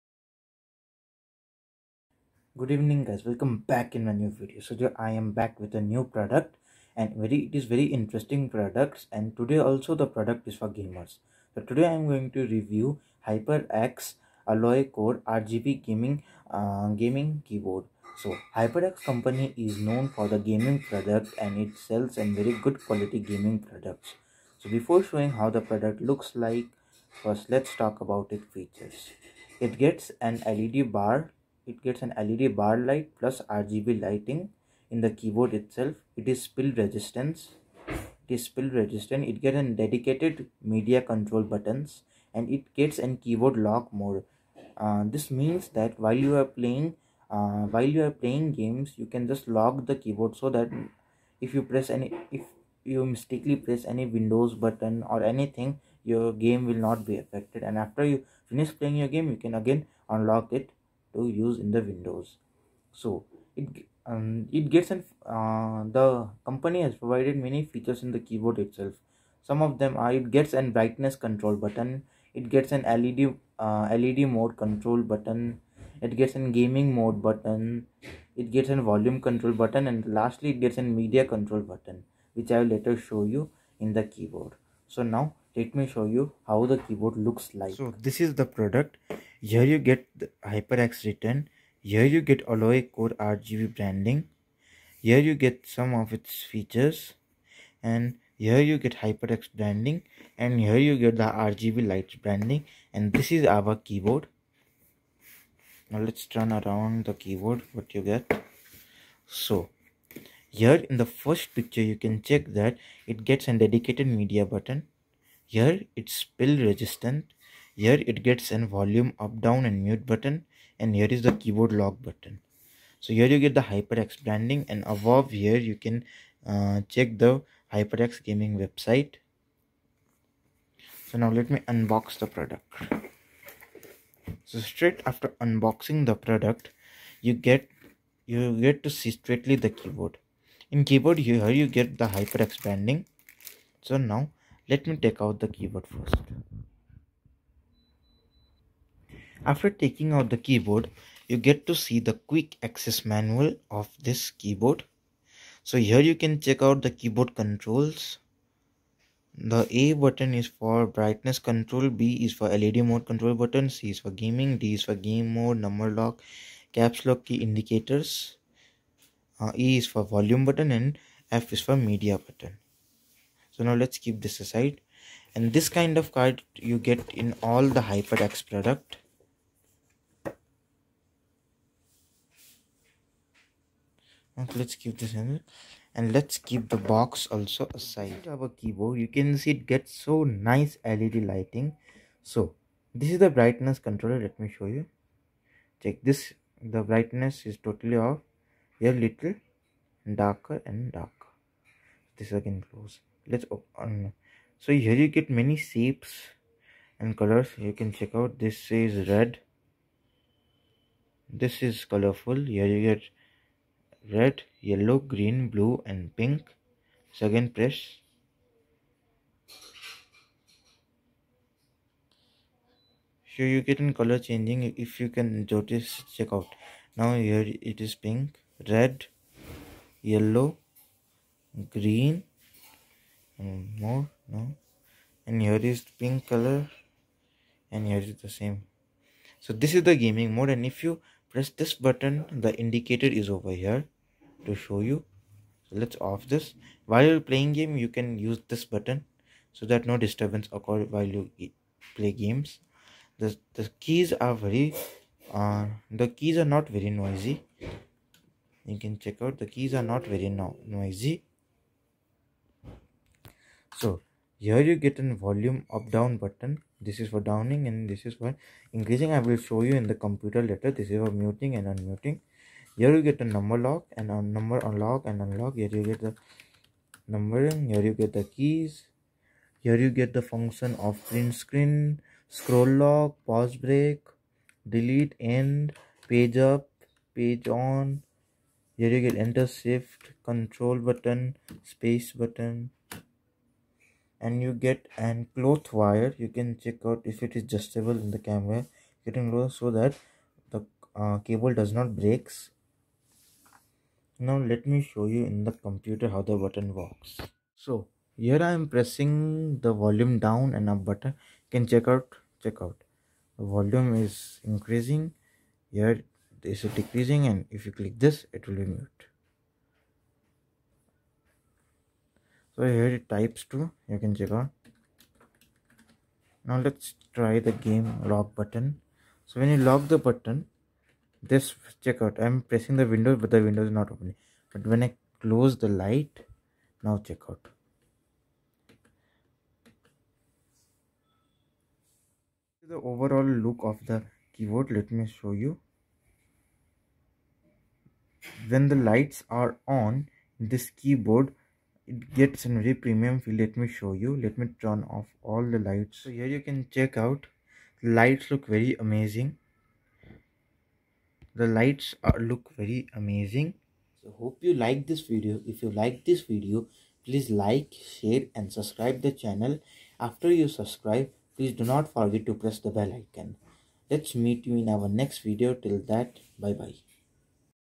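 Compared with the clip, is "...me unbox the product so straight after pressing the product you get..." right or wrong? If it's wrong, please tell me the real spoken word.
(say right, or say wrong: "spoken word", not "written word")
wrong: "unboxing", not "pressing".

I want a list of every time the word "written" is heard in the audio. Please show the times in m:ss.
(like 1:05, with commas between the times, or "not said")
1:31.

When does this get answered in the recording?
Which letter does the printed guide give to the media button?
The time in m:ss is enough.
2:51.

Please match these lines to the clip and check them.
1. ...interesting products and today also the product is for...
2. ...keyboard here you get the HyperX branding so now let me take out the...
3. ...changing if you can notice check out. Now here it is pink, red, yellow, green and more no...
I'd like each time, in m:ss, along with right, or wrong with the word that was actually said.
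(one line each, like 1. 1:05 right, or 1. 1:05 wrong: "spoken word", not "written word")
1. 0:07 right
2. 2:20 right
3. 3:44 right.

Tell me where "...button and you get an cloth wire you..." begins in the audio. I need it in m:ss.
4:52.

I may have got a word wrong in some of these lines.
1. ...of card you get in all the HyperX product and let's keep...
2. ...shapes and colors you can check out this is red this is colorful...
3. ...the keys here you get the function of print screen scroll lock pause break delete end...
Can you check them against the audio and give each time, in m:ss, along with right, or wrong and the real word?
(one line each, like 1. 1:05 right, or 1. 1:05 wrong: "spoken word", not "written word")
1. 2:55 right
2. 3:25 right
3. 4:38 right.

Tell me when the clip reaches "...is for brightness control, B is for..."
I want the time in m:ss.
2:40.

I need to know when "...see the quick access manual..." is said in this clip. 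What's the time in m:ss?
2:31.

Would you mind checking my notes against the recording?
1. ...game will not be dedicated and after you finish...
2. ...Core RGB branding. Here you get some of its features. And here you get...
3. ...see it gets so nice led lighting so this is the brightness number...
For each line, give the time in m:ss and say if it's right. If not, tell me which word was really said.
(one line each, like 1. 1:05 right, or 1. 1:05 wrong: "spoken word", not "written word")
1. 0:56 wrong: "affected", not "dedicated"
2. 1:32 right
3. 3:09 wrong: "controller", not "number".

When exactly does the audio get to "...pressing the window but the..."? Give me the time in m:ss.
5:32.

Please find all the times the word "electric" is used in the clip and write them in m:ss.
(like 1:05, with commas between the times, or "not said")
not said.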